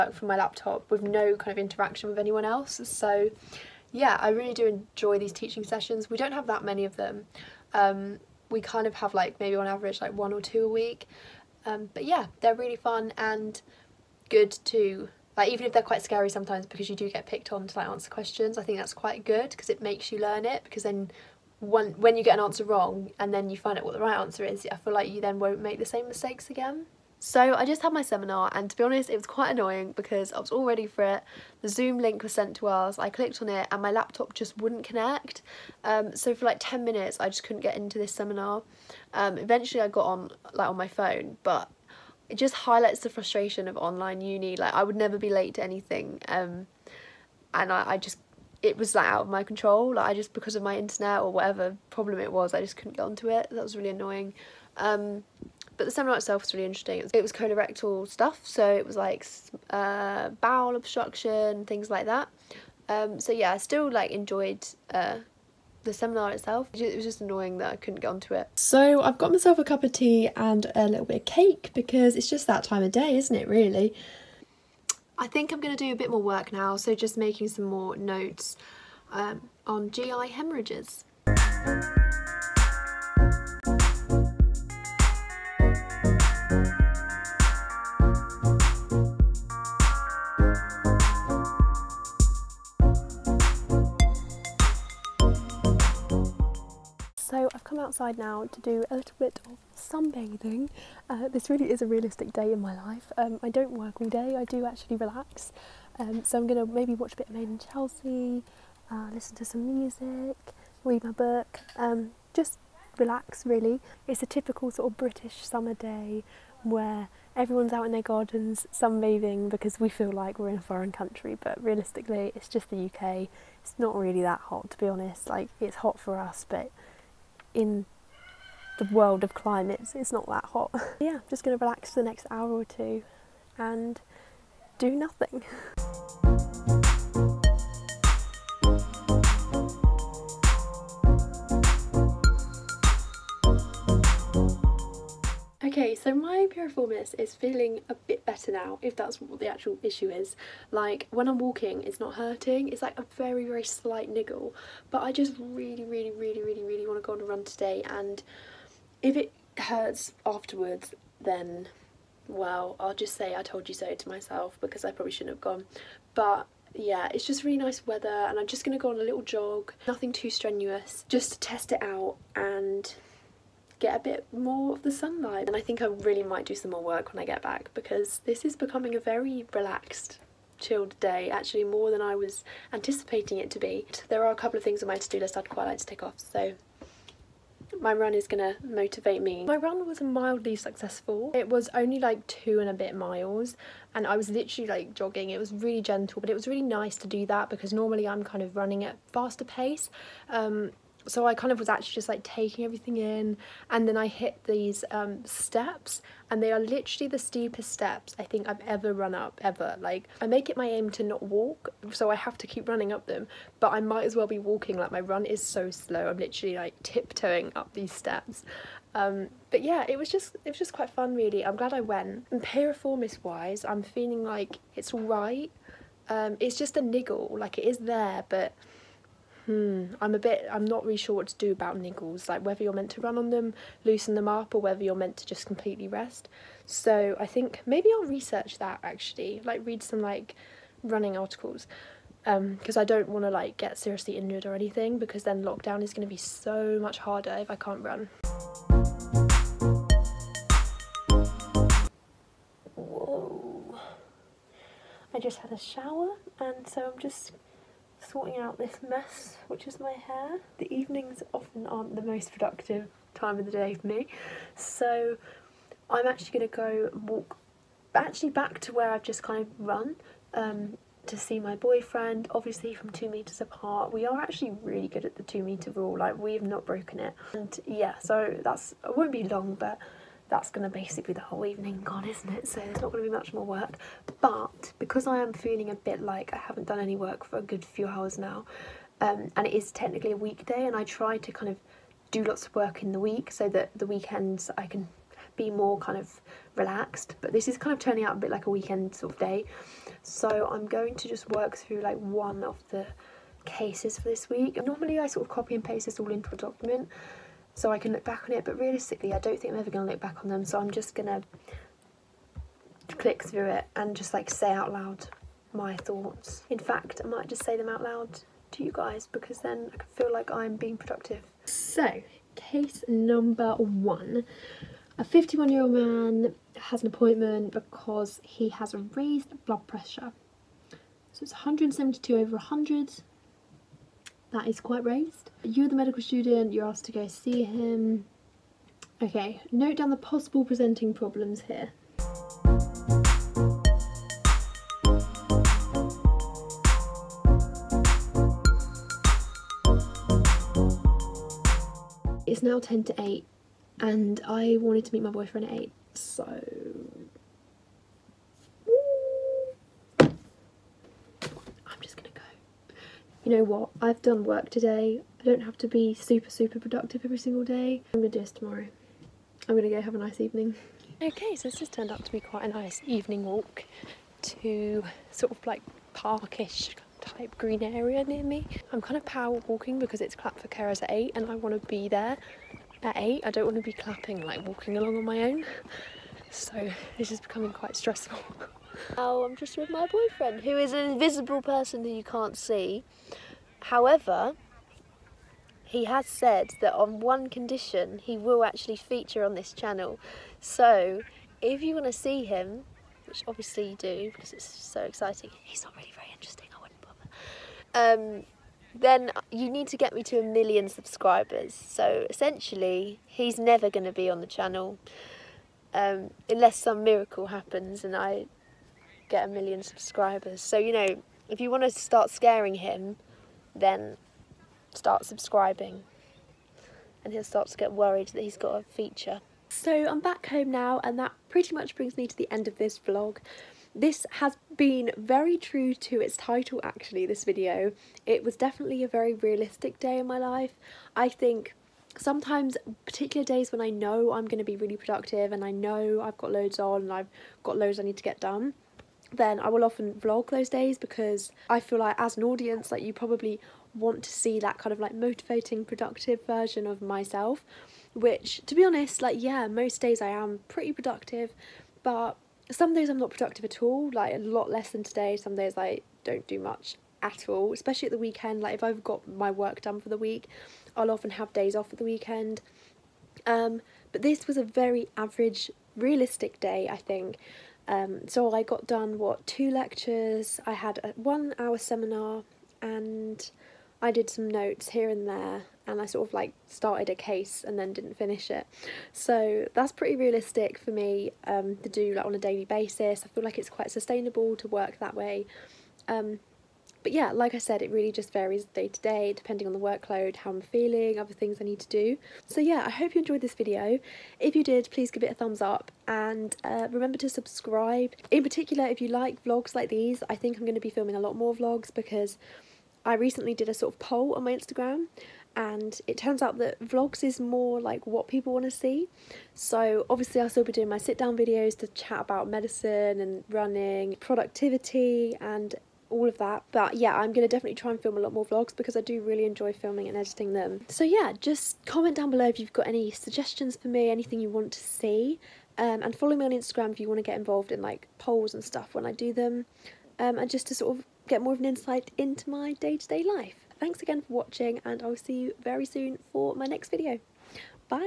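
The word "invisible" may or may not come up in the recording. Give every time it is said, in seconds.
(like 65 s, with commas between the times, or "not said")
390 s.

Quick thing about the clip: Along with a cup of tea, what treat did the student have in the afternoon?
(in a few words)
Cake.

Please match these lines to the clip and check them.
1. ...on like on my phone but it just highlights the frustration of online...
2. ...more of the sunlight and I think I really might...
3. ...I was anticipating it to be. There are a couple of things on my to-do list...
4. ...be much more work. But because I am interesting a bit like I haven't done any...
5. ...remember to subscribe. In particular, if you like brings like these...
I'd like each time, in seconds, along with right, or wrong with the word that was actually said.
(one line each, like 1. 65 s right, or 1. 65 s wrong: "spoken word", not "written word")
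1. 40 s right
2. 174 s right
3. 182 s right
4. 283 s wrong: "feeling", not "interesting"
5. 506 s wrong: "vlogs", not "brings".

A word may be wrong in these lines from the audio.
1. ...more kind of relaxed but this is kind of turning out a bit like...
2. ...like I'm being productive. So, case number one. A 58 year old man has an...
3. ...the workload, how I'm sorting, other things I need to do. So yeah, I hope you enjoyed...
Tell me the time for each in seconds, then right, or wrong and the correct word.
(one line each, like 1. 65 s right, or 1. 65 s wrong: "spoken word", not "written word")
1. 295 s right
2. 320 s wrong: "51", not "58"
3. 499 s wrong: "feeling", not "sorting".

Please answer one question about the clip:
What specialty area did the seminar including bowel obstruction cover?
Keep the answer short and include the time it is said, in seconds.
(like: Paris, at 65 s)
Colorectal, at 57 s.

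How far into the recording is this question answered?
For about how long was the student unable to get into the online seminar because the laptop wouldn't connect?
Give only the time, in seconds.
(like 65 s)
36 s.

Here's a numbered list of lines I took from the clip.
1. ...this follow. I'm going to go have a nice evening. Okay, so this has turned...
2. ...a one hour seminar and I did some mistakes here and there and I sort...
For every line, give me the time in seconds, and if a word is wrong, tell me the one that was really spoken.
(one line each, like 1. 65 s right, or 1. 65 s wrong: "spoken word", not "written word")
1. 368 s wrong: "tomorrow", not "follow"
2. 480 s wrong: "notes", not "mistakes".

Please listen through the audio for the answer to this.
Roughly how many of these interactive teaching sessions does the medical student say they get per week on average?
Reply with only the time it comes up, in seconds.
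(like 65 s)
10 s.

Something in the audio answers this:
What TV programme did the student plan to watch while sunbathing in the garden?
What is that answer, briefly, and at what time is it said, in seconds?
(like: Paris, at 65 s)
Made in Chelsea, at 107 s.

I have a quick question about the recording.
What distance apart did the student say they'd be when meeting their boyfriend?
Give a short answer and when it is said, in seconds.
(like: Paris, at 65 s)
2 metres, at 272 s.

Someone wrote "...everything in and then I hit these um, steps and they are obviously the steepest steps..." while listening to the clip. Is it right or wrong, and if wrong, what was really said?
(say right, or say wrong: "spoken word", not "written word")
wrong: "literally", not "obviously".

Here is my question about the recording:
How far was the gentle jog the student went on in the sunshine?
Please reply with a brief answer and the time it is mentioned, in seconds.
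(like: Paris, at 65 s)
Two and a bit miles, at 192 s.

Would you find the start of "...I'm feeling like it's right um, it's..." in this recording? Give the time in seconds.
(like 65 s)
223 s.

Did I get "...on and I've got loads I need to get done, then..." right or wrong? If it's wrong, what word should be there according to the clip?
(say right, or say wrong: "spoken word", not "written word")
right.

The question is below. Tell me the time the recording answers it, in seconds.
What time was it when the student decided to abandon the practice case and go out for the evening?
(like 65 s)
352 s.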